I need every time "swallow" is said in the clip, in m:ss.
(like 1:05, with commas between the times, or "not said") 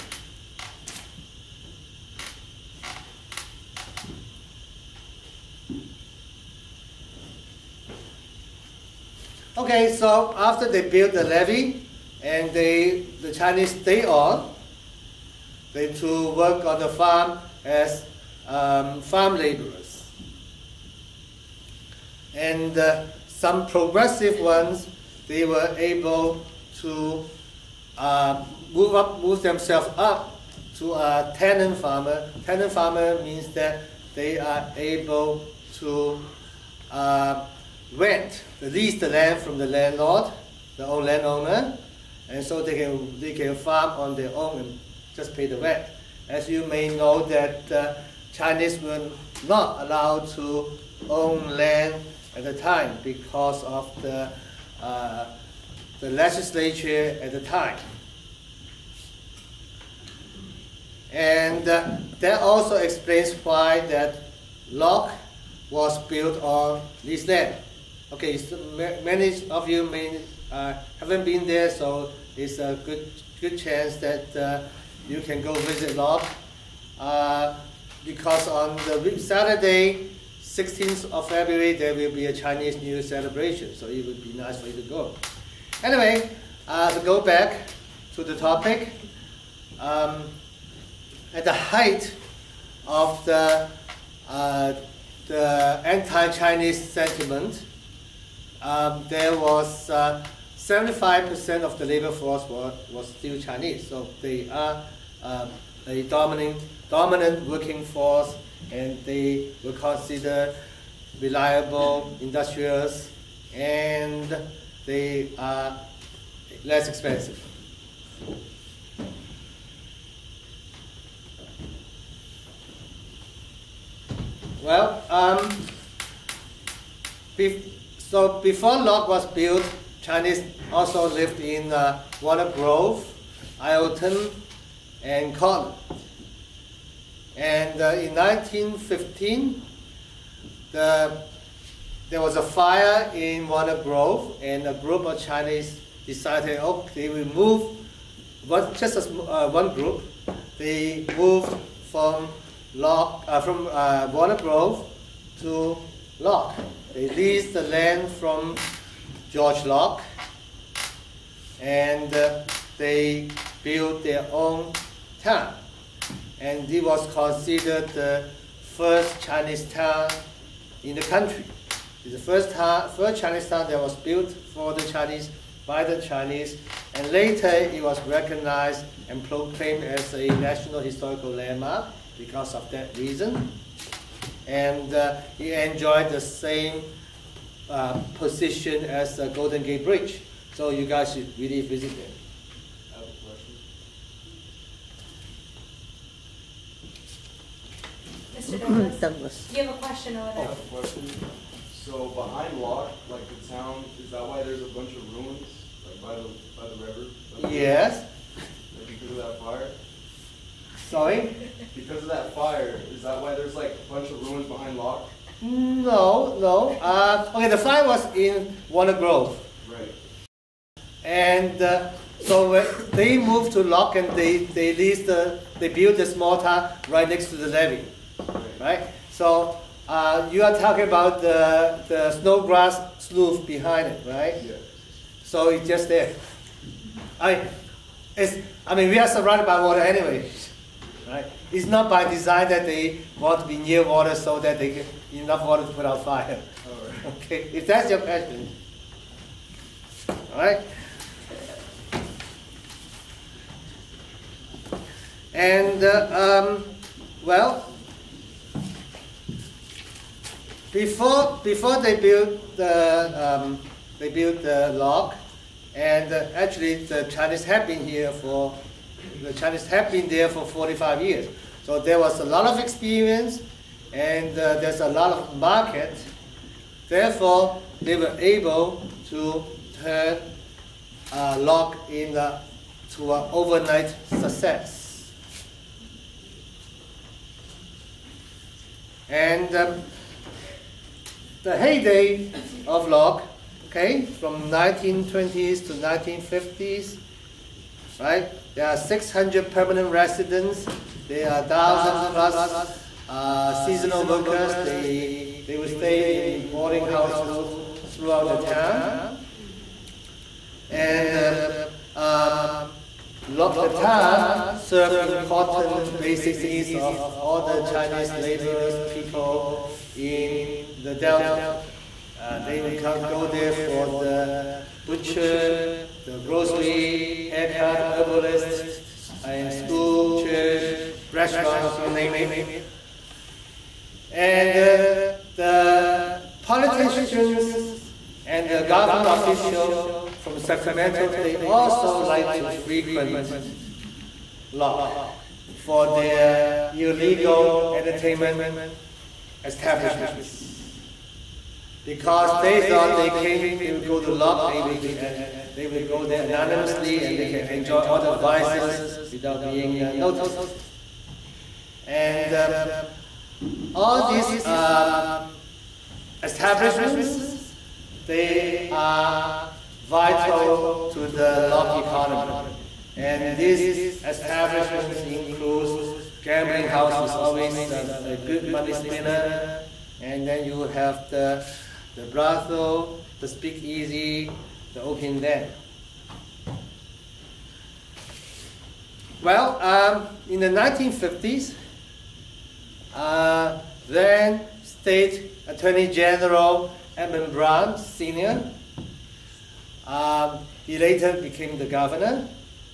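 not said.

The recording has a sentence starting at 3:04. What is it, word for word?
And uh, it enjoyed the same uh, position as the Golden Gate Bridge.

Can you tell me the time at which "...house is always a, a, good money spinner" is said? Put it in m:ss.
6:16.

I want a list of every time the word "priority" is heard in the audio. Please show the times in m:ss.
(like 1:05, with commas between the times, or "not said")
not said.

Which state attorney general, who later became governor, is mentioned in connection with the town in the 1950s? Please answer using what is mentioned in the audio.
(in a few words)
Edmund Brown Sr.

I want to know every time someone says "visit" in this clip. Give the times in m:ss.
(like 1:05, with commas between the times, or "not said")
1:15, 3:11.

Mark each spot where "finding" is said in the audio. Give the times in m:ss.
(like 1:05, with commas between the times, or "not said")
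not said.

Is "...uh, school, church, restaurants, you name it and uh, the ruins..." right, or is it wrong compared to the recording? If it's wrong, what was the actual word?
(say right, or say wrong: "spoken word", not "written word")
wrong: "politicians", not "ruins".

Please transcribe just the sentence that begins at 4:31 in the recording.
So there was a lot of experience, and uh, there's a lot of market.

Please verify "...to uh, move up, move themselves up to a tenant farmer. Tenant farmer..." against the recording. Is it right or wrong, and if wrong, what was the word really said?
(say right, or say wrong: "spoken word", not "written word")
right.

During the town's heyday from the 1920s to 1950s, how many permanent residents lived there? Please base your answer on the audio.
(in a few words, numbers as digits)
600.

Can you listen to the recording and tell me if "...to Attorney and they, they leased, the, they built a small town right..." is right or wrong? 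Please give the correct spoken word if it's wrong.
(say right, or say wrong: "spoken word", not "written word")
wrong: "Locke", not "Attorney".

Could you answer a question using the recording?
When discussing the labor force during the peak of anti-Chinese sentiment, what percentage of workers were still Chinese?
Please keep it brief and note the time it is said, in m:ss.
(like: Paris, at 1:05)
75%, at 1:40.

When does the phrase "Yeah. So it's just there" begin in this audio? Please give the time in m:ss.
3:54.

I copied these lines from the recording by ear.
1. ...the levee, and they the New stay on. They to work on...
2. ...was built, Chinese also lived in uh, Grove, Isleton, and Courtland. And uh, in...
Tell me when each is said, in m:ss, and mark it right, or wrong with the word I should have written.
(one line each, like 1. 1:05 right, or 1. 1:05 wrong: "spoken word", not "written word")
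1. 0:11 wrong: "Chinese", not "New"
2. 2:09 right.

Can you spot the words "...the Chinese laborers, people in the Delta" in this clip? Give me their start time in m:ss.
5:17.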